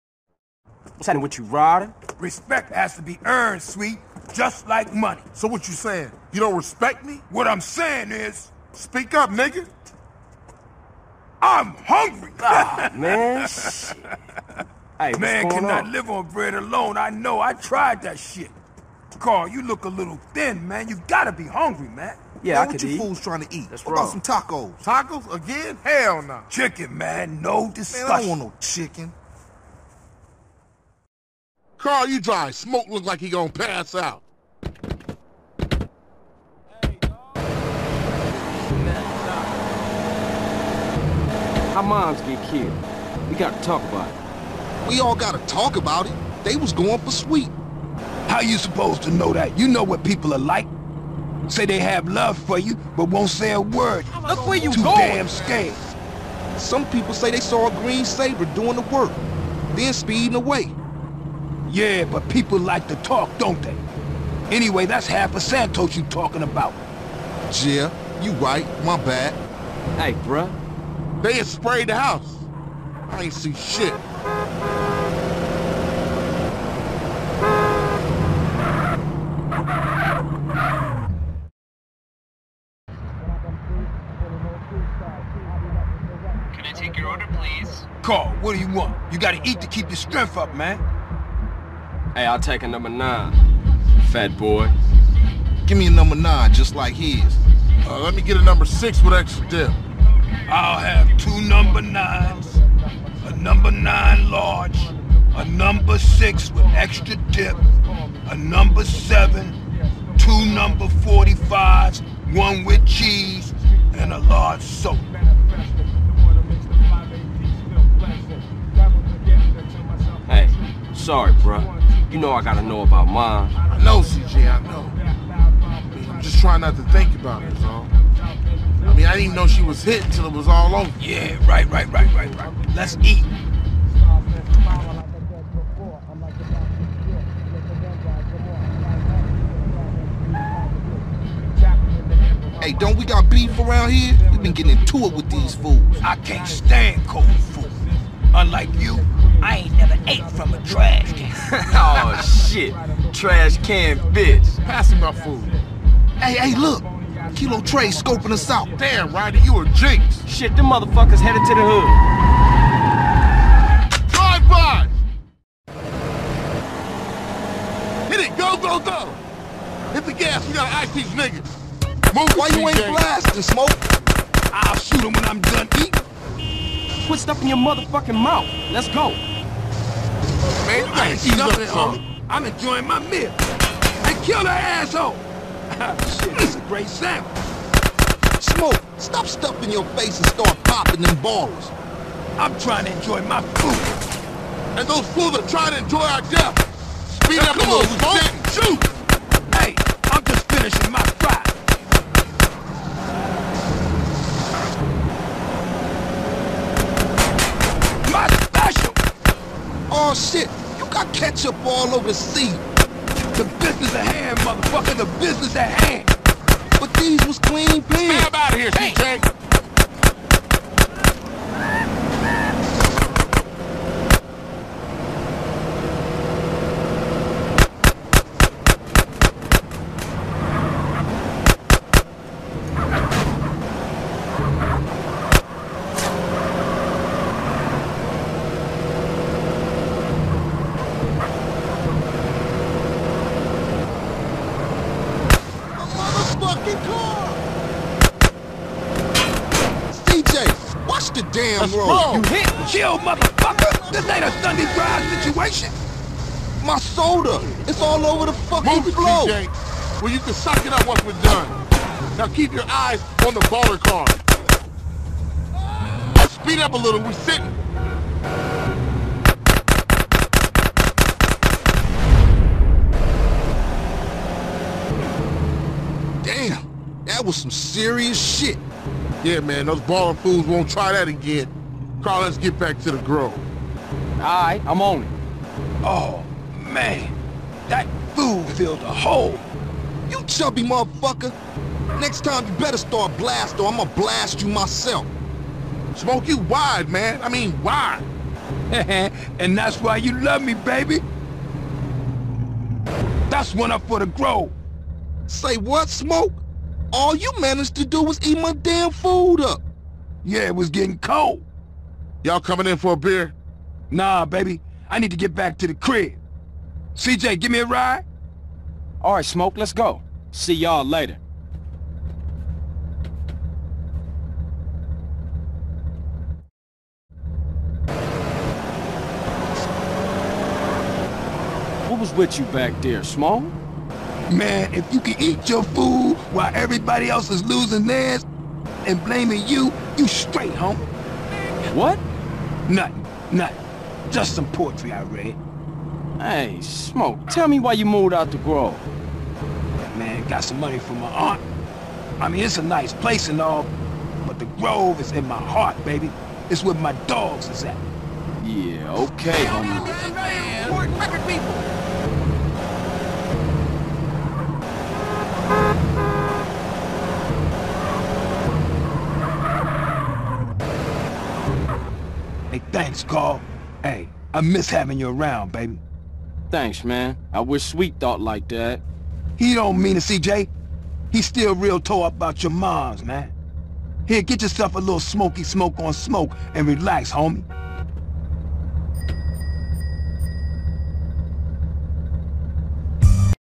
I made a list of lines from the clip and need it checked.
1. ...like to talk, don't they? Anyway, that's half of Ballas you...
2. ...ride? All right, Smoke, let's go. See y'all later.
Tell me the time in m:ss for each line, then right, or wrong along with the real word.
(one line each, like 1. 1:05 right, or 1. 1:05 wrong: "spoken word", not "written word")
1. 1:02 wrong: "Santos", not "Ballas"
2. 5:17 right.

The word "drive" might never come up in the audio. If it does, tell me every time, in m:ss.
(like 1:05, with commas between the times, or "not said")
0:32, 2:44, 4:14.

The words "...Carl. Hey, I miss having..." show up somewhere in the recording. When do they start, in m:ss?
6:13.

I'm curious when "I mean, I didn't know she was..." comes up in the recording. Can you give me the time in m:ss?
2:08.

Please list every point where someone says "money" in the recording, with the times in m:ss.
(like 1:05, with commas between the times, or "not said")
0:04, 5:50.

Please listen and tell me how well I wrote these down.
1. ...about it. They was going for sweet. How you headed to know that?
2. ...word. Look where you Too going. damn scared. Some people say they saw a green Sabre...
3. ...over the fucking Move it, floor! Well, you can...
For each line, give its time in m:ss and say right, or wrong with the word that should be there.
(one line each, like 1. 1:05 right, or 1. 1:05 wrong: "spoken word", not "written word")
1. 0:45 wrong: "supposed", not "headed"
2. 0:53 right
3. 4:18 right.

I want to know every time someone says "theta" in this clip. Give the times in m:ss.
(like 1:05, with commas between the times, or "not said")
not said.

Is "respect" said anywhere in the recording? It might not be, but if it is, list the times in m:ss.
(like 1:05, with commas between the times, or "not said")
0:02, 0:06.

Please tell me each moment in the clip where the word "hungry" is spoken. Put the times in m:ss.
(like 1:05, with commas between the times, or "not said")
0:11, 0:21.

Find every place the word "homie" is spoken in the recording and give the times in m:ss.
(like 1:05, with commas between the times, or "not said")
5:40, 5:59, 6:27.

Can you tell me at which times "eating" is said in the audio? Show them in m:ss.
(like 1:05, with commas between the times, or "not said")
2:55.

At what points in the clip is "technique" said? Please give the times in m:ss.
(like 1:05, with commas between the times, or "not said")
not said.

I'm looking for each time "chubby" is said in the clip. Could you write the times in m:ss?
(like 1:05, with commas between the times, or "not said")
4:50.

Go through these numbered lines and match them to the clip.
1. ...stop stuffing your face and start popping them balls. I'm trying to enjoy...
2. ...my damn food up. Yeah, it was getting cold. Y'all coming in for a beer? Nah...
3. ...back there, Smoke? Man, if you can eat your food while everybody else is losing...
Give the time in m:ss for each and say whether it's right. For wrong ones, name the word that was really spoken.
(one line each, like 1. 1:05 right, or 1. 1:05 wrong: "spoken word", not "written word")
1. 3:08 right
2. 5:08 right
3. 5:32 right.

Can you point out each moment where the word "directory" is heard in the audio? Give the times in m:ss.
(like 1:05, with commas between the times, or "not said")
not said.